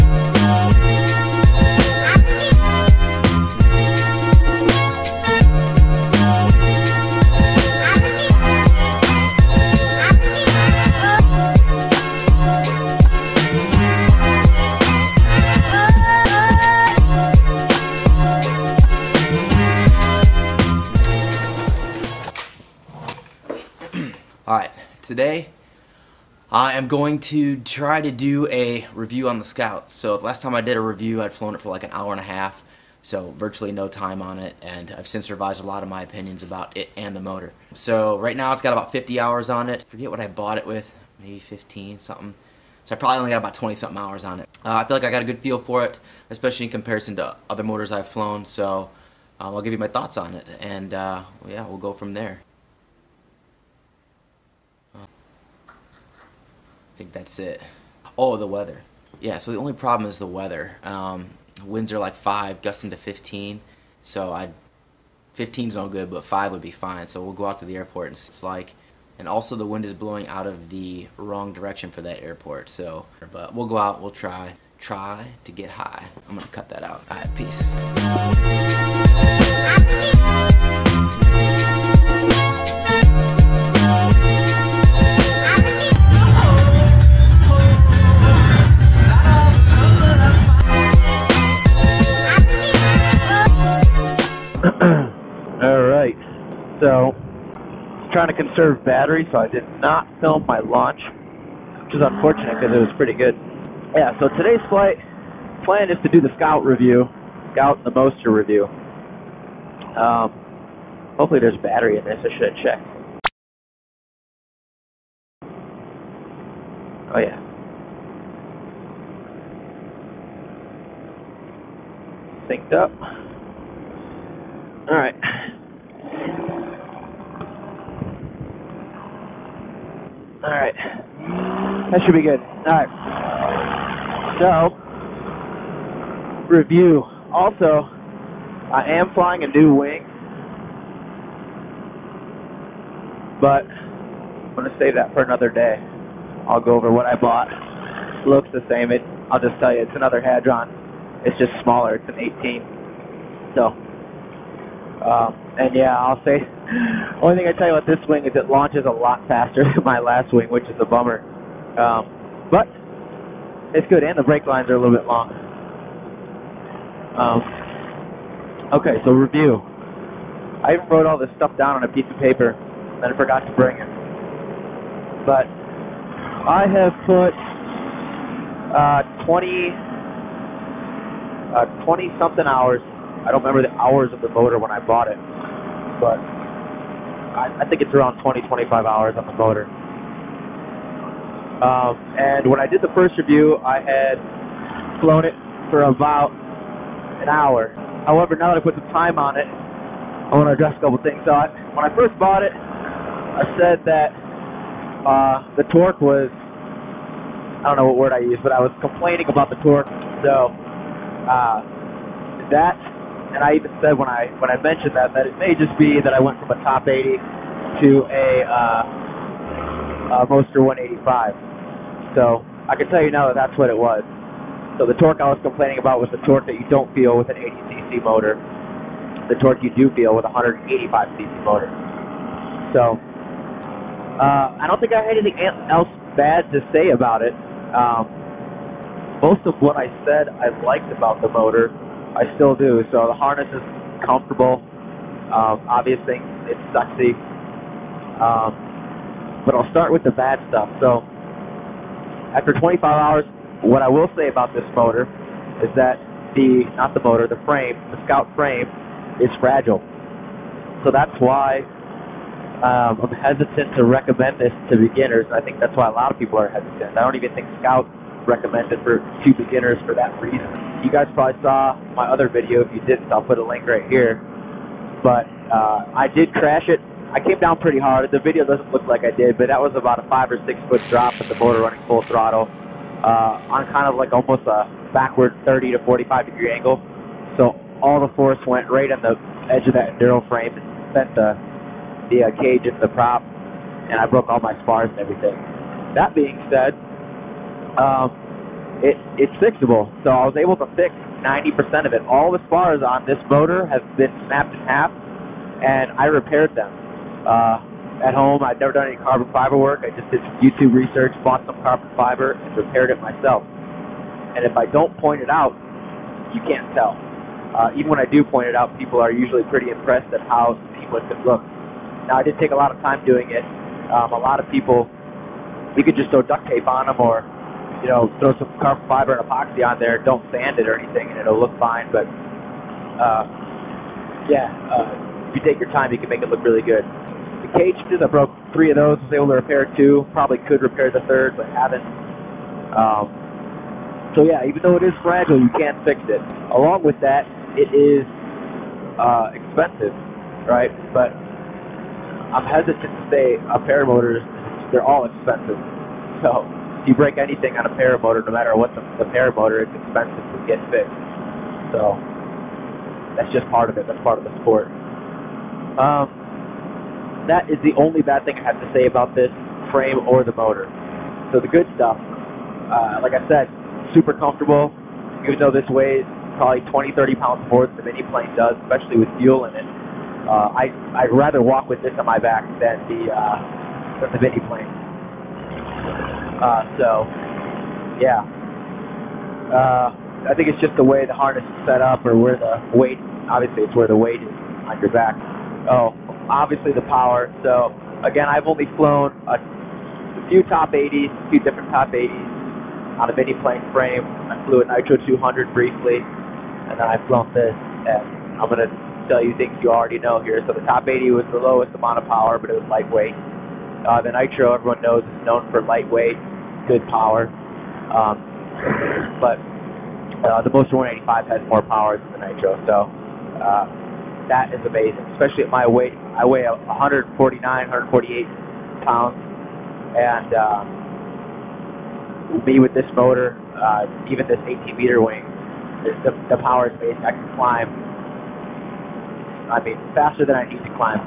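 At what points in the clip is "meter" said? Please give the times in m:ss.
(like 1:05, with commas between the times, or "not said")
7:14.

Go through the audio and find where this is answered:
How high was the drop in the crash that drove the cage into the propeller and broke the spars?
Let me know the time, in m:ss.
4:40.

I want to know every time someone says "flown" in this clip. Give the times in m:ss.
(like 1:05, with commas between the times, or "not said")
0:31, 0:48, 3:15, 6:38, 6:47.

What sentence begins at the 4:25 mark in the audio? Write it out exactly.
I think that's why a lot of people are hesitant.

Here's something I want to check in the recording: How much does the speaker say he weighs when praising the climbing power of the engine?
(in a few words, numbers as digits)
149 pounds.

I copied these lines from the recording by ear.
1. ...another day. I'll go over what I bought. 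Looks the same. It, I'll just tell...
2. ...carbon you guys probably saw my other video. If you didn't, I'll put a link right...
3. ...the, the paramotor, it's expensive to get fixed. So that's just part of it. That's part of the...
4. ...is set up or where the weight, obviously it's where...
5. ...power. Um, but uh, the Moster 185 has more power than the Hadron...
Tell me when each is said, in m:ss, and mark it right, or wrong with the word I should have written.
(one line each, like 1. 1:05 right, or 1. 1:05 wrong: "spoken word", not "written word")
1. 2:25 right
2. 4:30 wrong: "reason", not "carbon"
3. 5:58 right
4. 6:31 right
5. 6:56 wrong: "Nitro", not "Hadron".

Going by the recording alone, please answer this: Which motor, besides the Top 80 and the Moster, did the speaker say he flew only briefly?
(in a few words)
Nitro 200.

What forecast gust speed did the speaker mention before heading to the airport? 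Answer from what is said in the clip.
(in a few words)
15.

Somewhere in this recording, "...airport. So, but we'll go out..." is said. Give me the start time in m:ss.
1:12.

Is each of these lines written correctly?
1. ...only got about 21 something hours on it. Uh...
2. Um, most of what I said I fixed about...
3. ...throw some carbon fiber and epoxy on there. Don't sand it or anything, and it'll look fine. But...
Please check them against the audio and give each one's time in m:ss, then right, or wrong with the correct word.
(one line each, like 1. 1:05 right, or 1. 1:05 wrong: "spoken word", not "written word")
1. 0:43 wrong: "20", not "21"
2. 3:57 wrong: "liked", not "fixed"
3. 5:28 right.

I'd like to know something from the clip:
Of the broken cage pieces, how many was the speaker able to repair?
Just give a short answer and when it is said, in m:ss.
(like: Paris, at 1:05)
2, at 5:39.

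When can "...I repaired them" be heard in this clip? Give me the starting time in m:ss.
5:05.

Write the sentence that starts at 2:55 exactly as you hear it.
But I have put uh, 20, uh, 20 something hours.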